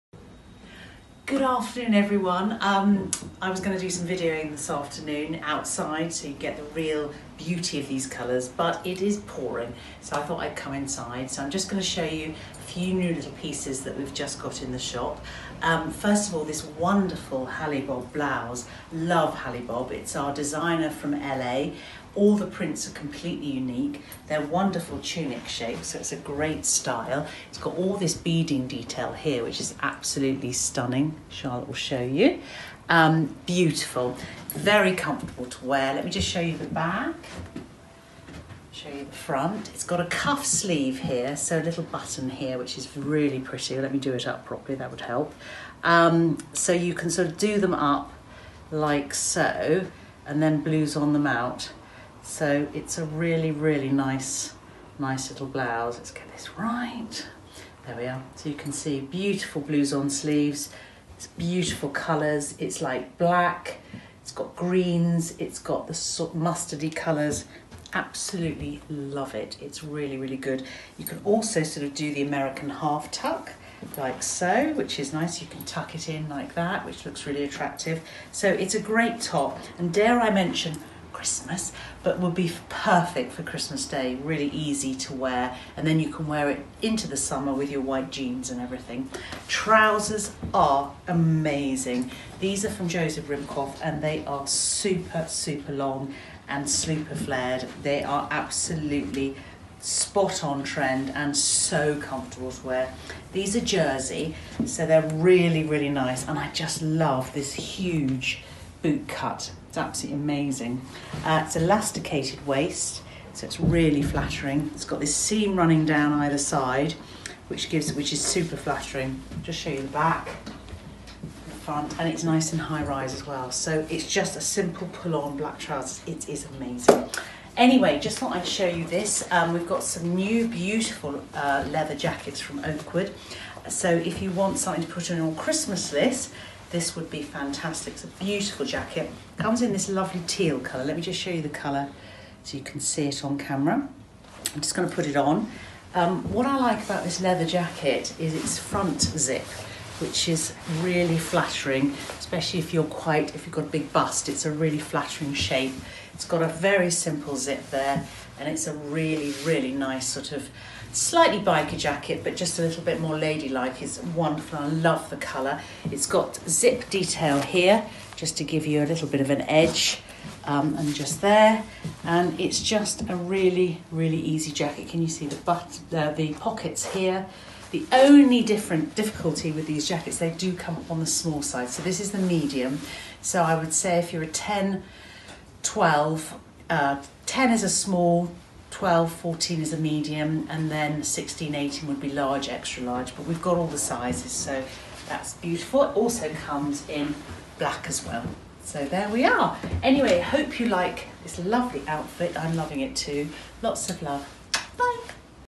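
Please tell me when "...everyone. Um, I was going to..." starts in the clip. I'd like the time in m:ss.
0:01.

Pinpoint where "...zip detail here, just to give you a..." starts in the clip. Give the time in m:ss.
2:46.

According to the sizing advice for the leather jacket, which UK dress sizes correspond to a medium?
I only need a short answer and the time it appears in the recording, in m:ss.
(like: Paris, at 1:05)
12 to 14, at 3:08.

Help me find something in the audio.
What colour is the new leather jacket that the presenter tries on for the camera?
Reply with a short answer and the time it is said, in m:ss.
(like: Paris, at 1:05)
Teal, at 2:20.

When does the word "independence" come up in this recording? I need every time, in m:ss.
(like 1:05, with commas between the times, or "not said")
not said.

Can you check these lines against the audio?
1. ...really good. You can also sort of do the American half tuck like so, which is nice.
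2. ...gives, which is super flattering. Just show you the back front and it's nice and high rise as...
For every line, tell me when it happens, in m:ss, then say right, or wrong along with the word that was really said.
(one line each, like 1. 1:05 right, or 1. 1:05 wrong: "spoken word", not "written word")
1. 1:10 right
2. 1:57 right.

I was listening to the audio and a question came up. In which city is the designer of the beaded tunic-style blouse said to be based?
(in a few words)
LA.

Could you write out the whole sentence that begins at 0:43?
Let me do it up properly, that would help.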